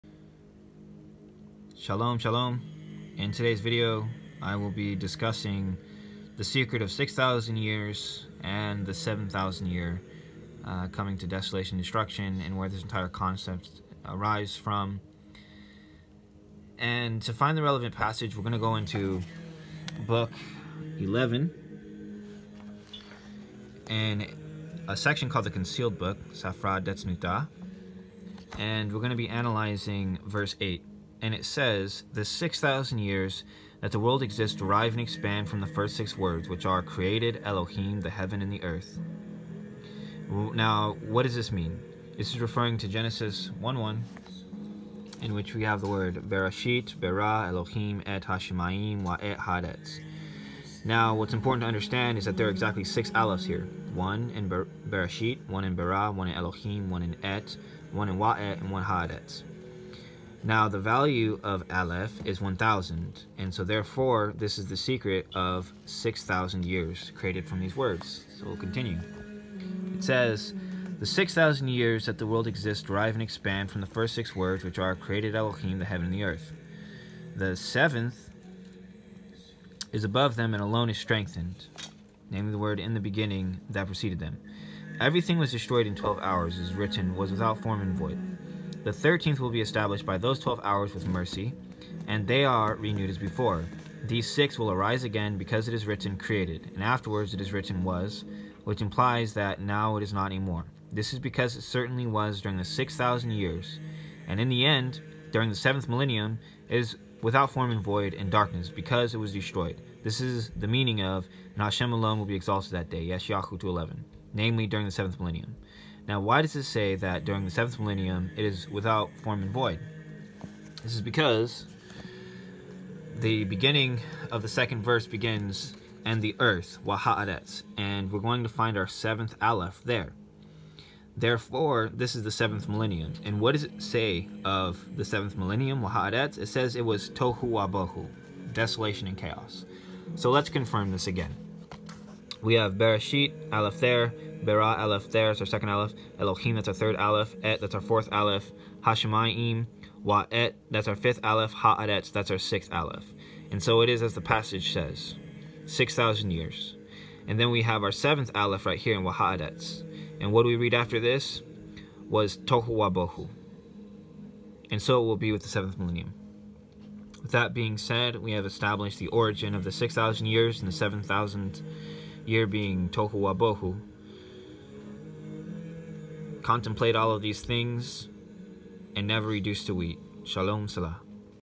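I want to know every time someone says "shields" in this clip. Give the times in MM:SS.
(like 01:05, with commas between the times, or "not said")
not said.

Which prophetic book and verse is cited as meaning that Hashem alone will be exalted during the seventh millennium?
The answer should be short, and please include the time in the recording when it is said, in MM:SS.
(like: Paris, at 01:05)
Yeshayahu 2:11, at 01:53.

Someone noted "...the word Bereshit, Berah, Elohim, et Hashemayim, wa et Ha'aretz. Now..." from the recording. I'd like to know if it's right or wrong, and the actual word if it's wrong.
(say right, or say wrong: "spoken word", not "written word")
right.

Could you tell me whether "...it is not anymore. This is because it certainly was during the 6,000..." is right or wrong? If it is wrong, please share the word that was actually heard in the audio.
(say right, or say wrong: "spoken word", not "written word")
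right.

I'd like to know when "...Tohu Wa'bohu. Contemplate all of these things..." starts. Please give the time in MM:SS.
02:52.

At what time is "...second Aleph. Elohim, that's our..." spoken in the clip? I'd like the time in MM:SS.
02:25.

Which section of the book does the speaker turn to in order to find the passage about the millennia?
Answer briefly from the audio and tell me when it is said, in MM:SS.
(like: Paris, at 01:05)
Safra Detznuta, at 00:26.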